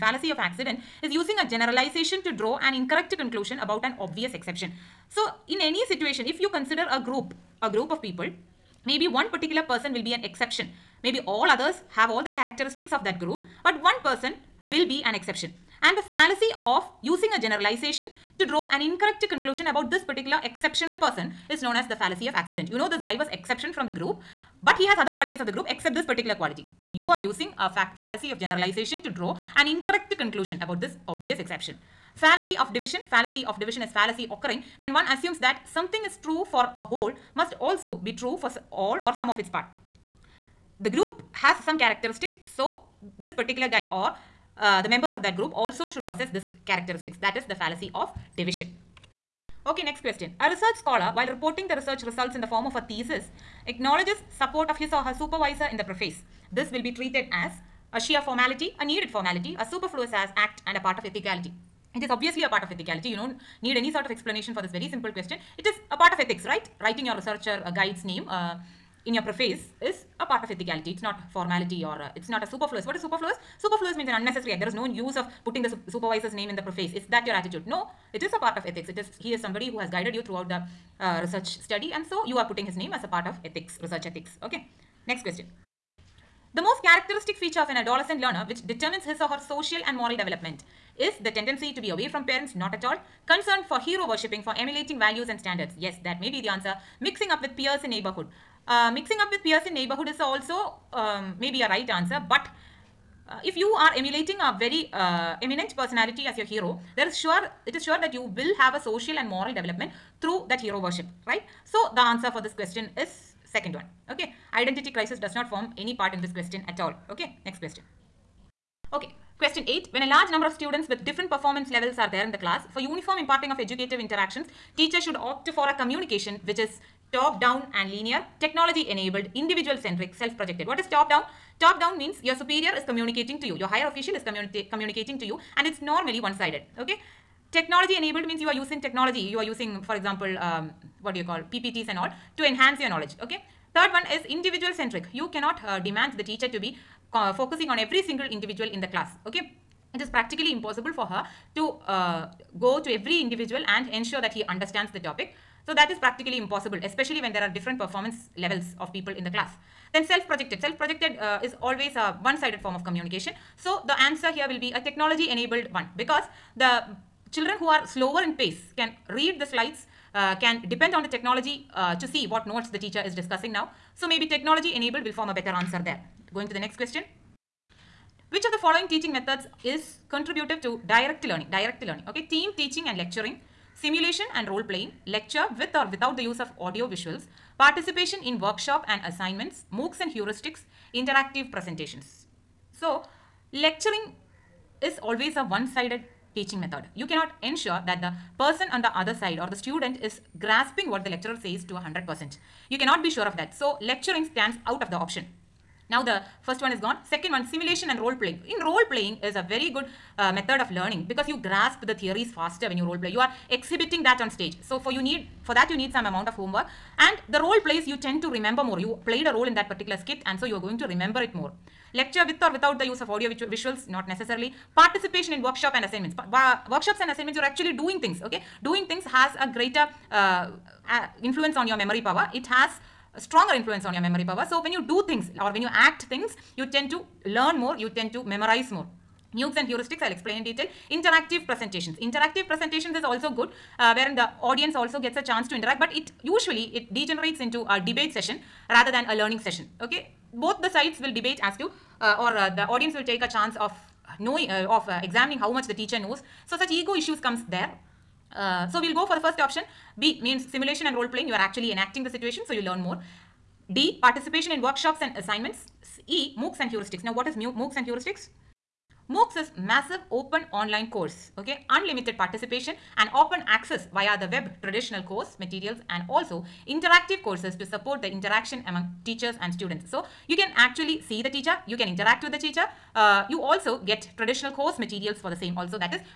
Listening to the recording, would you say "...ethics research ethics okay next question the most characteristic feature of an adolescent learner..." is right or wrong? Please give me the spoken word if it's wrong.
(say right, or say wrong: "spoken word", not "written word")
right.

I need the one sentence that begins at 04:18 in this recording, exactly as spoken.
Uh, so we'll go for the first option.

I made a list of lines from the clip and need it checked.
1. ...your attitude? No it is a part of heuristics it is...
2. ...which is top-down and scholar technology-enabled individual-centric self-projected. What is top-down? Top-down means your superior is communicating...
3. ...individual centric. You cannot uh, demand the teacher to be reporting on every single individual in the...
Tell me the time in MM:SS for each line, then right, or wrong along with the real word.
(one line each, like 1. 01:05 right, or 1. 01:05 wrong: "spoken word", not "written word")
1. 01:17 wrong: "ethics", not "heuristics"
2. 02:06 wrong: "linear", not "scholar"
3. 02:24 wrong: "focusing", not "reporting".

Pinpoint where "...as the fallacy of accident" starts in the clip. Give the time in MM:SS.
00:21.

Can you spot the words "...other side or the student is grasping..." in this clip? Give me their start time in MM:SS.
03:18.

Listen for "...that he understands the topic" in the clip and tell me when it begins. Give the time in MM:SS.
02:34.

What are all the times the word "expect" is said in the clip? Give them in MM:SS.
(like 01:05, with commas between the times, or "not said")
not said.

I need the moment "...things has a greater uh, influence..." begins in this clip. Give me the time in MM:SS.
03:48.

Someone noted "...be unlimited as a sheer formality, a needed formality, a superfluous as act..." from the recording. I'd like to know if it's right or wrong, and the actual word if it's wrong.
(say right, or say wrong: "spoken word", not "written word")
wrong: "treated", not "unlimited".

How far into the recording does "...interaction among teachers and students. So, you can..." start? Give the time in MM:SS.
04:38.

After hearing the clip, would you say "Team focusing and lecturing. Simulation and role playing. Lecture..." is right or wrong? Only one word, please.
wrong.